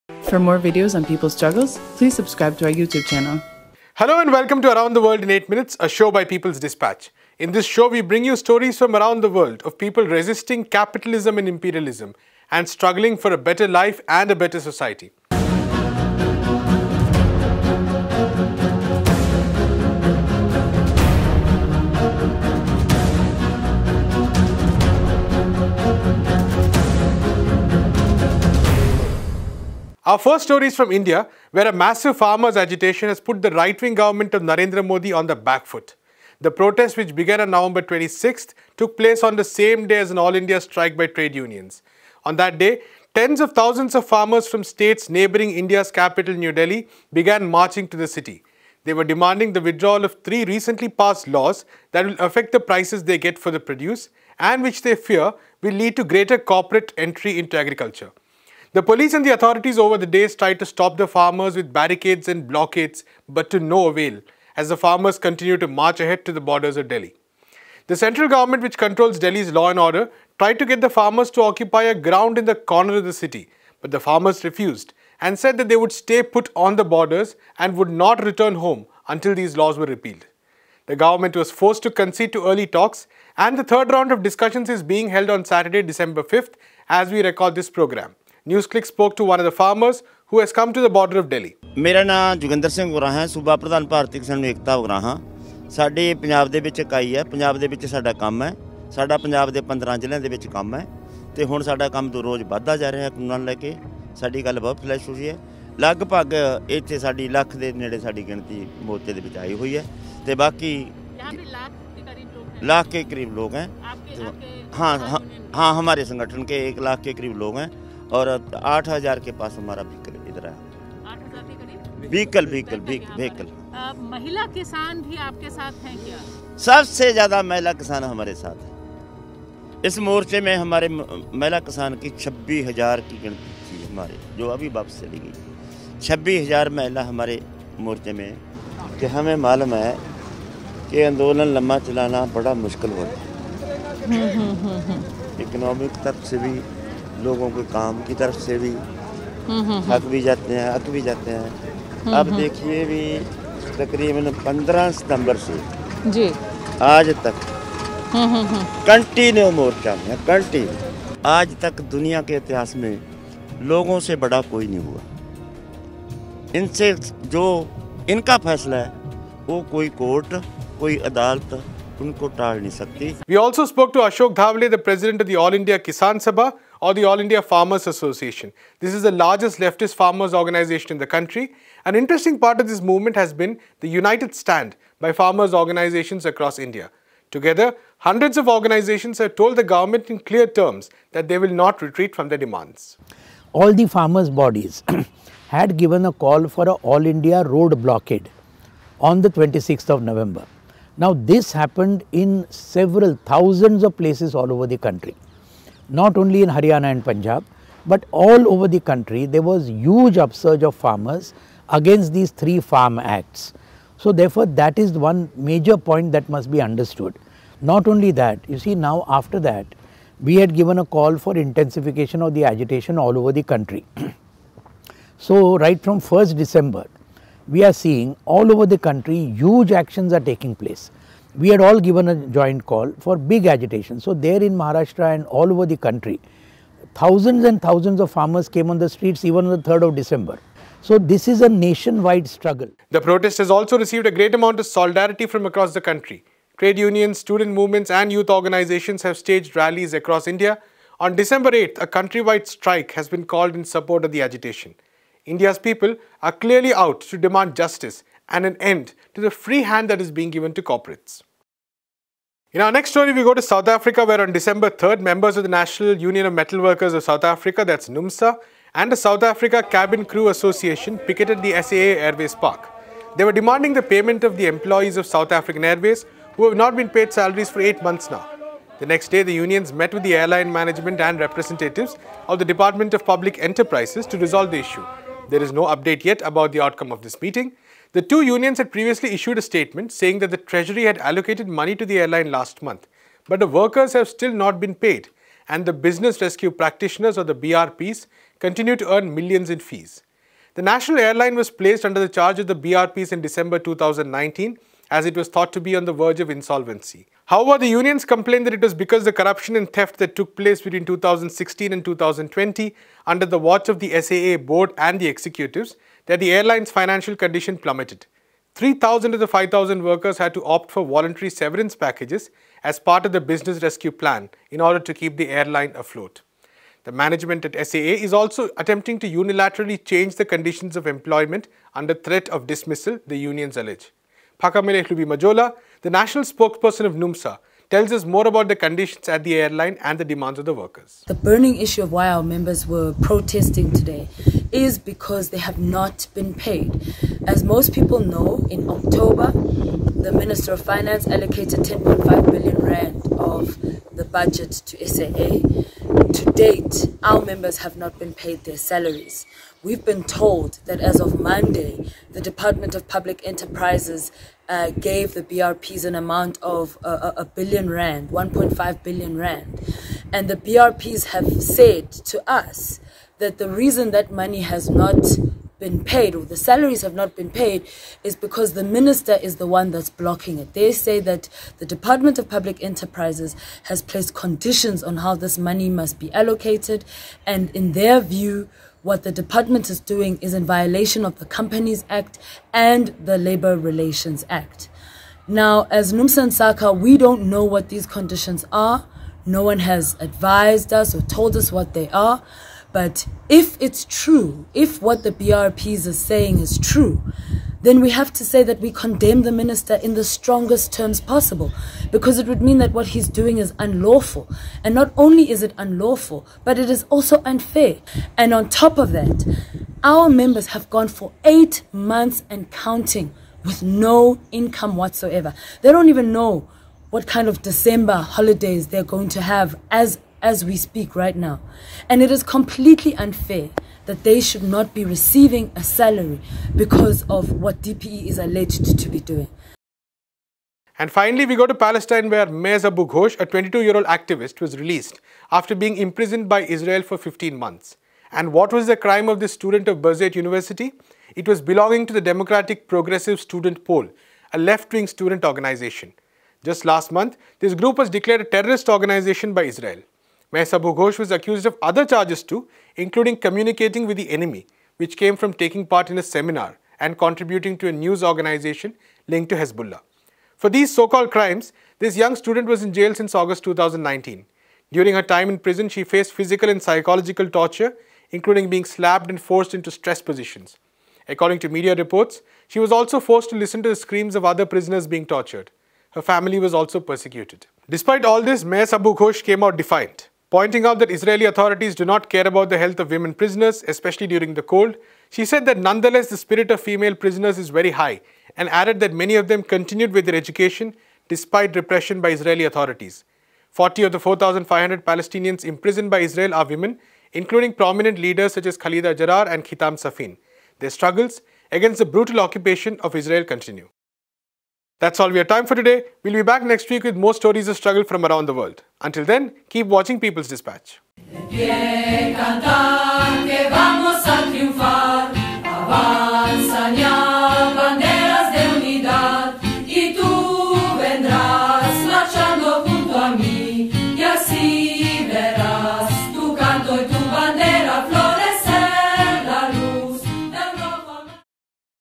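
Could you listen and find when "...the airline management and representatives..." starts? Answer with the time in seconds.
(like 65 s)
280 s.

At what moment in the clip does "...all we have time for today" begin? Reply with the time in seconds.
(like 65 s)
514 s.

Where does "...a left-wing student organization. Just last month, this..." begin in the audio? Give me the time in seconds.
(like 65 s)
454 s.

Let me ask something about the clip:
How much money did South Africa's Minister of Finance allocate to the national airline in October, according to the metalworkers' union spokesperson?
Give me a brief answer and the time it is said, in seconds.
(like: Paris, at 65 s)
10.5 billion rand, at 351 s.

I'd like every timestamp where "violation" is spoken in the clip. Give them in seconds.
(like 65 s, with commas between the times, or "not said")
390 s.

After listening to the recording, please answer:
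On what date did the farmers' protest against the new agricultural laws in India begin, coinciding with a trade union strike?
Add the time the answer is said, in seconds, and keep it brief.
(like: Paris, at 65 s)
November 26, at 37 s.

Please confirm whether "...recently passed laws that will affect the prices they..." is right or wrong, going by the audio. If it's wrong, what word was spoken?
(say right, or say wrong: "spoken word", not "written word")
right.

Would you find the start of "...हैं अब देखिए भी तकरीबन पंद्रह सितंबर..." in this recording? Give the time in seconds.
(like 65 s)
151 s.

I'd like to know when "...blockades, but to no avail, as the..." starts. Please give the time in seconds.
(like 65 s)
62 s.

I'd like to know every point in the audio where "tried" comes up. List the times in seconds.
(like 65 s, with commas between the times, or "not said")
60 s, 70 s.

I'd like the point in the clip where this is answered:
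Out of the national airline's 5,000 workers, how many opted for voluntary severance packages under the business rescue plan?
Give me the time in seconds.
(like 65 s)
318 s.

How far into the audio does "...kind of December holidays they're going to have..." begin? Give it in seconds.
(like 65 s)
427 s.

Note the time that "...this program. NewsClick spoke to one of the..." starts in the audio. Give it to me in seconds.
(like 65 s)
87 s.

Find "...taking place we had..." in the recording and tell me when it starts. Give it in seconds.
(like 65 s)
230 s.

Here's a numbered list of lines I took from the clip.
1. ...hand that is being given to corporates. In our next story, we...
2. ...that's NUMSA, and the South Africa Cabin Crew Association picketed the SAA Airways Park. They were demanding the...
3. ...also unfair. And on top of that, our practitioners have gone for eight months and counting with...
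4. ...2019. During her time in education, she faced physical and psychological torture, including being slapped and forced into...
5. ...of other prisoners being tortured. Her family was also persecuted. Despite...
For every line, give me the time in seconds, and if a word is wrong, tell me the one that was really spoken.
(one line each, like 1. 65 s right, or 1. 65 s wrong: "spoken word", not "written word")
1. 259 s right
2. 267 s right
3. 416 s wrong: "members", not "practitioners"
4. 473 s wrong: "prison", not "education"
5. 484 s right.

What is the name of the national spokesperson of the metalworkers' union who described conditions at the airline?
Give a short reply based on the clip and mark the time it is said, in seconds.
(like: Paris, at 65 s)
Phakamile Majola, at 334 s.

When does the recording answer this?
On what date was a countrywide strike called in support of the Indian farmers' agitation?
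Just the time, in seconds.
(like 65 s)
251 s.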